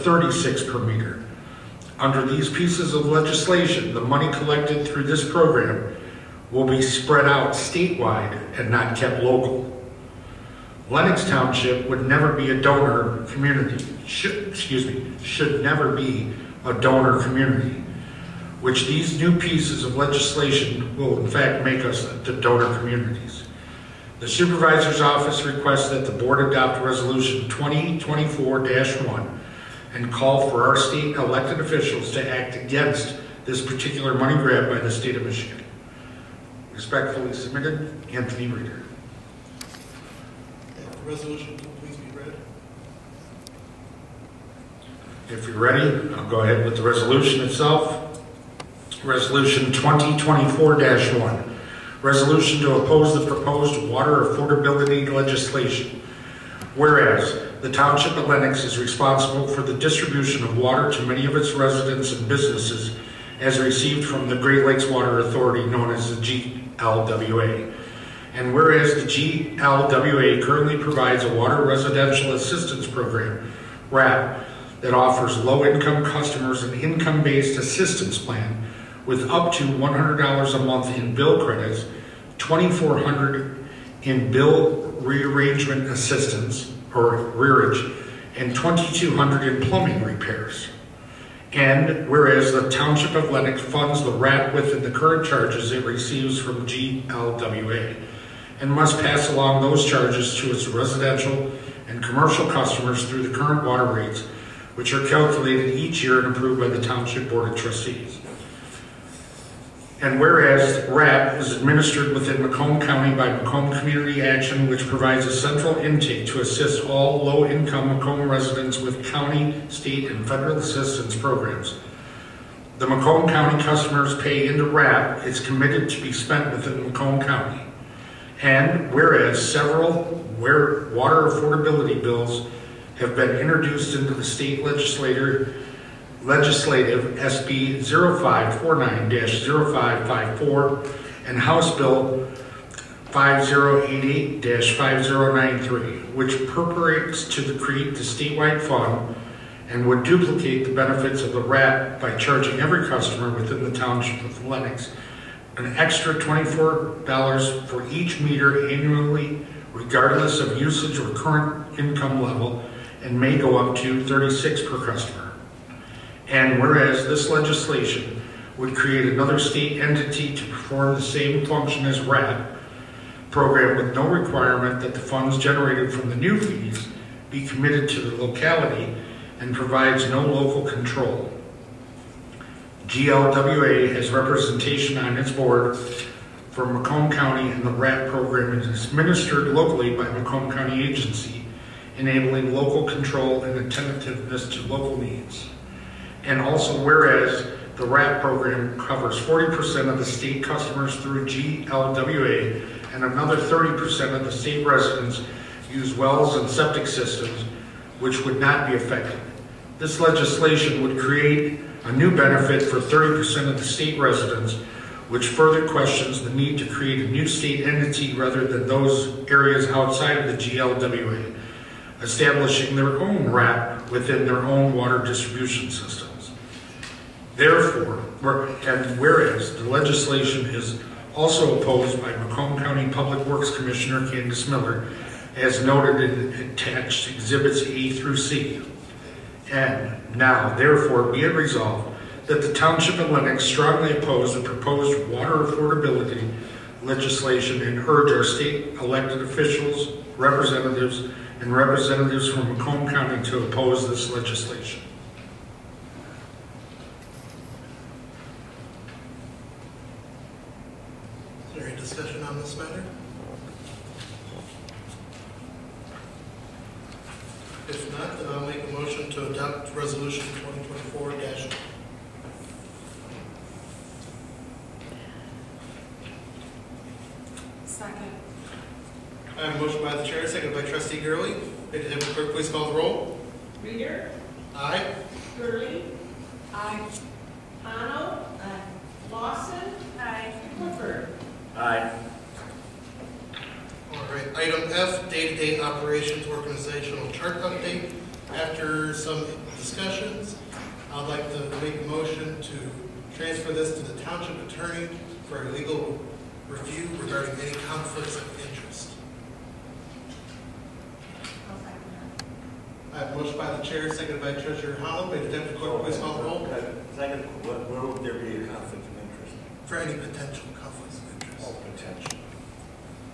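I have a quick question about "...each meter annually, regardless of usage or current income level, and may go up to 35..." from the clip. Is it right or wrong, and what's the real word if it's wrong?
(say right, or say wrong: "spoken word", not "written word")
wrong: "36", not "35".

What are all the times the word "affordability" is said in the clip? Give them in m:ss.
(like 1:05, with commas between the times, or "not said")
0:54, 2:10, 4:05.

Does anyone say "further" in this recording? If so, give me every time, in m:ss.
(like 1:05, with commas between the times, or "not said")
3:35.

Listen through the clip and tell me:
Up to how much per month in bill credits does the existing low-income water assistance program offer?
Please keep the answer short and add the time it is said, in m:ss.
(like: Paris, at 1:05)
$100, at 1:19.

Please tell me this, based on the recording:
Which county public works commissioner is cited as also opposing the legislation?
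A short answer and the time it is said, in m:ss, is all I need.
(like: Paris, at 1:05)
Candice Miller, at 3:54.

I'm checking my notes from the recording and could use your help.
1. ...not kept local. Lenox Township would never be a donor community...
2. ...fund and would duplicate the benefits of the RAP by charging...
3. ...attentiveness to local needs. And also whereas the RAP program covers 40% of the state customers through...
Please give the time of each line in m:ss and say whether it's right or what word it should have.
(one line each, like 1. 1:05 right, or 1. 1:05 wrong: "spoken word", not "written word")
1. 0:08 right
2. 2:28 right
3. 3:13 right.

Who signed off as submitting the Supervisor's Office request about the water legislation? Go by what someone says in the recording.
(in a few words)
Anthony Reeder.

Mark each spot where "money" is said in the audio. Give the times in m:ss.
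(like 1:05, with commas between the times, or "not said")
0:03, 0:34.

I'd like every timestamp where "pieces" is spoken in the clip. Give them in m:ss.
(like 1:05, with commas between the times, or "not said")
0:02, 0:19.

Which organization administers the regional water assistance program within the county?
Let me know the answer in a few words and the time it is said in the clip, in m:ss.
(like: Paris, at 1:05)
Macomb Community Action, at 1:53.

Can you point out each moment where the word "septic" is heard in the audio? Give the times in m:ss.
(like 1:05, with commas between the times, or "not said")
3:26.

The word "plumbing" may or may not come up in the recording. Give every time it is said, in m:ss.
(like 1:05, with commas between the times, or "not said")
1:29.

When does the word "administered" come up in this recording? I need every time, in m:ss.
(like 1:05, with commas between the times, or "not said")
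1:51, 3:08.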